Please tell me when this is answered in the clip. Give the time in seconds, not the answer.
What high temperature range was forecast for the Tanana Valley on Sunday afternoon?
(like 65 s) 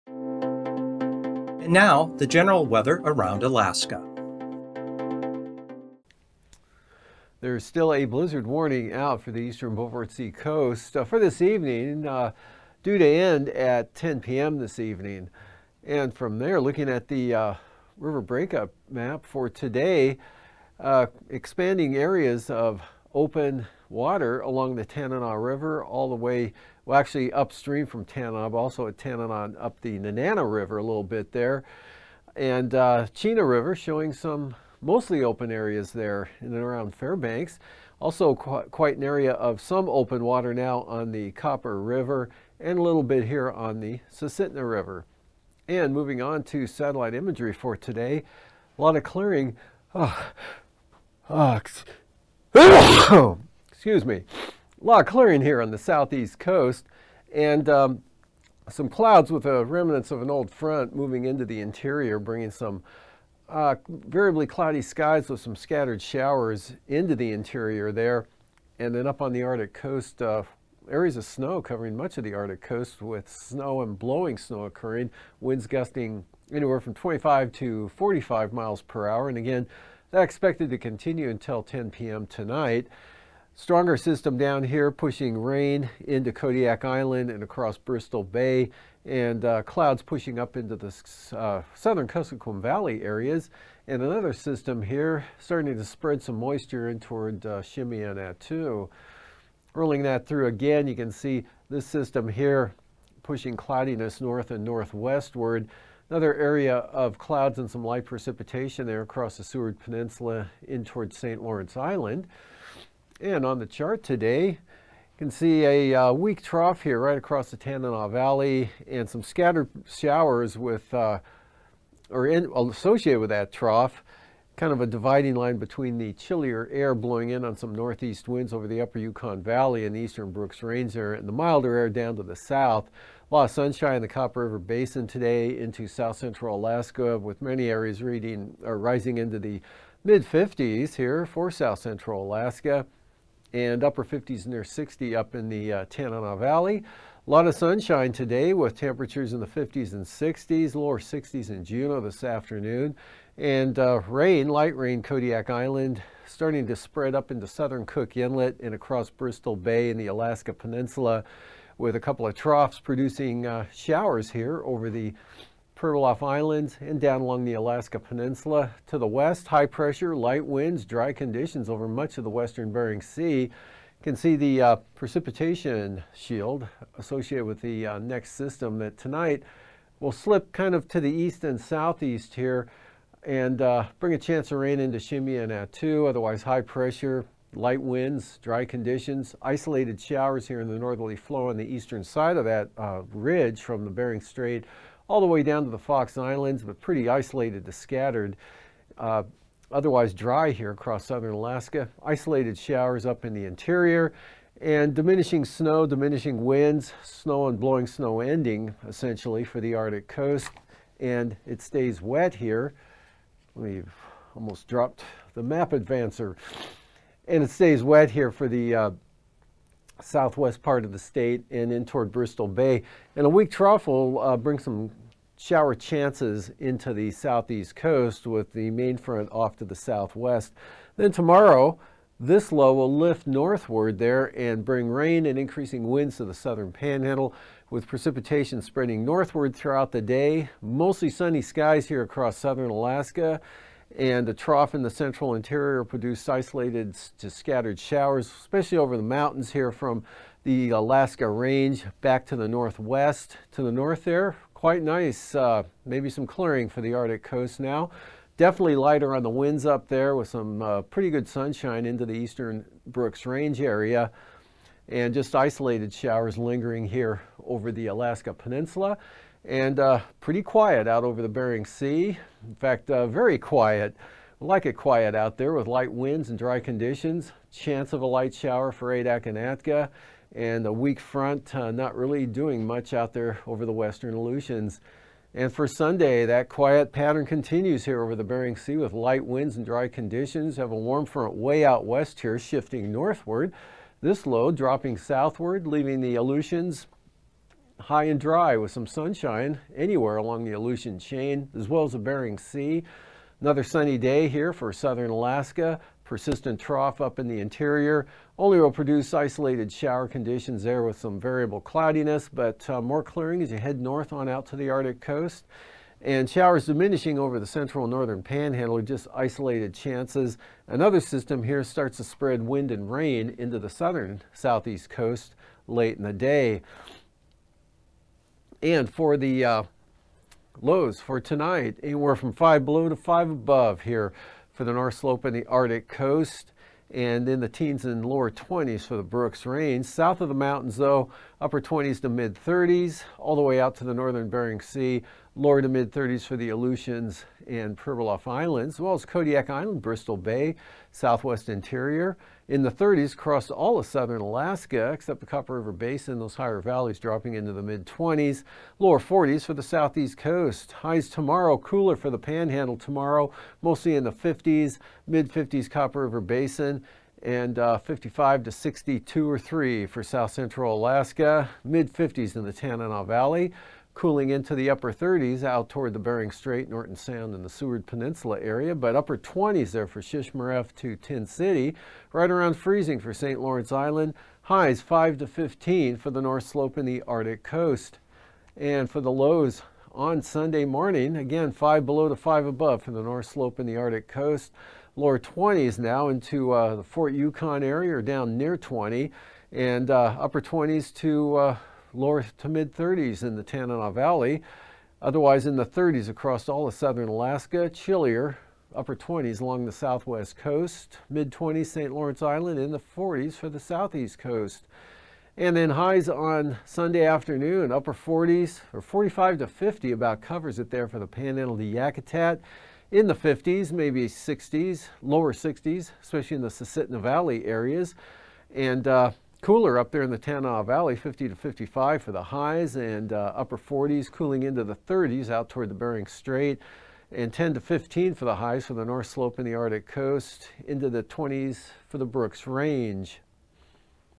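430 s.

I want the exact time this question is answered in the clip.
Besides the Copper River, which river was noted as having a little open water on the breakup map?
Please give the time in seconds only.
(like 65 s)
44 s.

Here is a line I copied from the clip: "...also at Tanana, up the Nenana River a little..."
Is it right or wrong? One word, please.
right.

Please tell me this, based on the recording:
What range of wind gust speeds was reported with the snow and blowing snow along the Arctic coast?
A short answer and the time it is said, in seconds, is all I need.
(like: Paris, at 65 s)
25 to 45 mph, at 76 s.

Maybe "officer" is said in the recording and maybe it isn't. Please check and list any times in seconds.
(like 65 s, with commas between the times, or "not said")
not said.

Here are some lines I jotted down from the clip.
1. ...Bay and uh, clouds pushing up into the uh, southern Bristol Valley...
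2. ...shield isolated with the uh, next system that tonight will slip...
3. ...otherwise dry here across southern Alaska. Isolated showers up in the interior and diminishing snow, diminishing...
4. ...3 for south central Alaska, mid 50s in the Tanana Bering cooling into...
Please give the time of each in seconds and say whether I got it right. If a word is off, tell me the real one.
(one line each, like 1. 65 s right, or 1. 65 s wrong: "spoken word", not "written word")
1. 88 s wrong: "Kuskokwim", not "Bristol"
2. 176 s wrong: "associated", not "isolated"
3. 199 s right
4. 369 s wrong: "Valley", not "Bering".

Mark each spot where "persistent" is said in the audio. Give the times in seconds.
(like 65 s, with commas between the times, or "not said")
306 s.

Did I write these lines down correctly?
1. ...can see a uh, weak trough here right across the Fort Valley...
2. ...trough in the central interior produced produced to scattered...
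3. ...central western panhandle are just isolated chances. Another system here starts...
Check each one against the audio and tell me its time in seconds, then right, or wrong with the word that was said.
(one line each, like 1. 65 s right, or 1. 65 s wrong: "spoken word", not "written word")
1. 115 s wrong: "Tanana", not "Fort"
2. 244 s wrong: "isolated", not "produced"
3. 317 s wrong: "northern", not "western".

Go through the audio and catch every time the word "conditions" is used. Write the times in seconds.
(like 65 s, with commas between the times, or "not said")
171 s, 188 s, 276 s, 289 s, 310 s.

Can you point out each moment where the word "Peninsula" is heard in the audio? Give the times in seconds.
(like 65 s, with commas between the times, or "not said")
109 s, 160 s, 167 s, 268 s, 377 s.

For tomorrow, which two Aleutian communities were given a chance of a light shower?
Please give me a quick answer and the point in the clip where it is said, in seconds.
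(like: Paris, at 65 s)
Adak and Atka, at 278 s.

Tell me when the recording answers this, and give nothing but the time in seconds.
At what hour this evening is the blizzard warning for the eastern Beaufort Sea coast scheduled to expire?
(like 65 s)
13 s.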